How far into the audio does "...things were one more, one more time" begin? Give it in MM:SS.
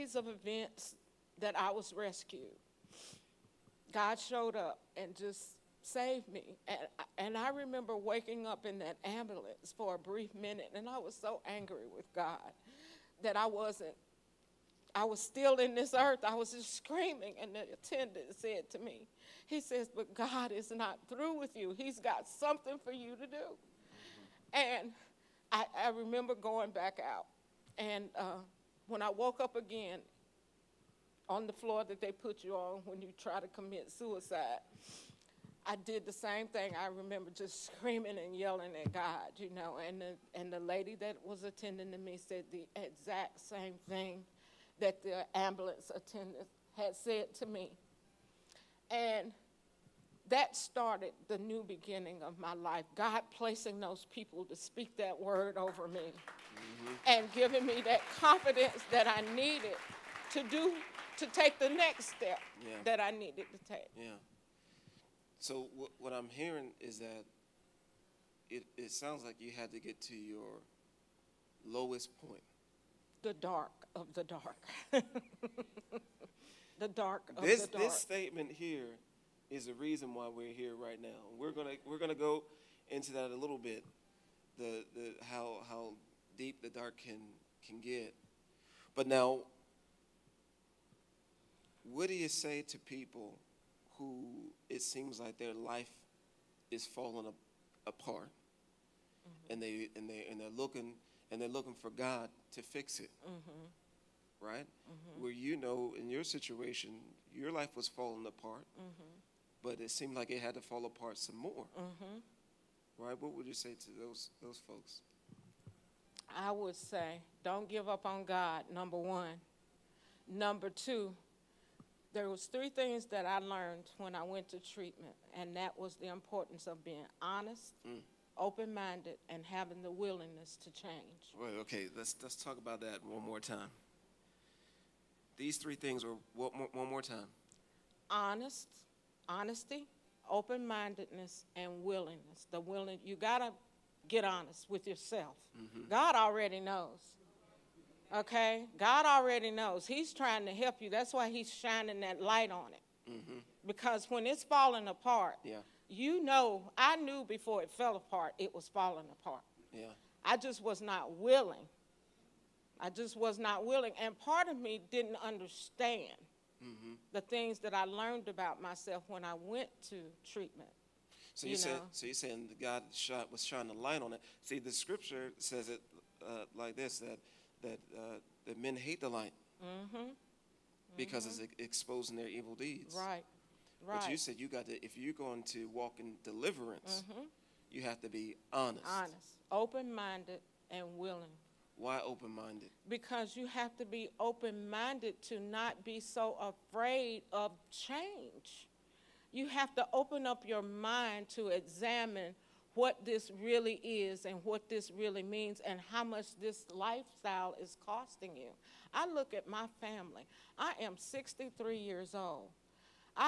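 02:15.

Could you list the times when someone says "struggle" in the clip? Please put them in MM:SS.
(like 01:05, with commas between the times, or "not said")
not said.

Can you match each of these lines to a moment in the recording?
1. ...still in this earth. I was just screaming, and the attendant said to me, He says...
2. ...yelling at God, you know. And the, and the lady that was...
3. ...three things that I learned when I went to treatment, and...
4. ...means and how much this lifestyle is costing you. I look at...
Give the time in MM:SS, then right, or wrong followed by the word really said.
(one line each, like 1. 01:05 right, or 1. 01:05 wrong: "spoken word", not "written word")
1. 00:15 right
2. 00:38 right
3. 02:02 right
4. 03:25 right.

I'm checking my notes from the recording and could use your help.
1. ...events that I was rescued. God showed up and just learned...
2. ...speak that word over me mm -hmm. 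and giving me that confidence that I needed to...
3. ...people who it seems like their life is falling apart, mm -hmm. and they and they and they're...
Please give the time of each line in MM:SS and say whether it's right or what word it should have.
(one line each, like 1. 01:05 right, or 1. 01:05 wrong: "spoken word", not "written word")
1. 00:00 wrong: "saved", not "learned"
2. 00:54 right
3. 01:32 right.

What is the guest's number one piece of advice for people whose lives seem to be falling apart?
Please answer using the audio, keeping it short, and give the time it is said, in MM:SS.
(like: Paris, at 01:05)
Don't give up on God, at 01:57.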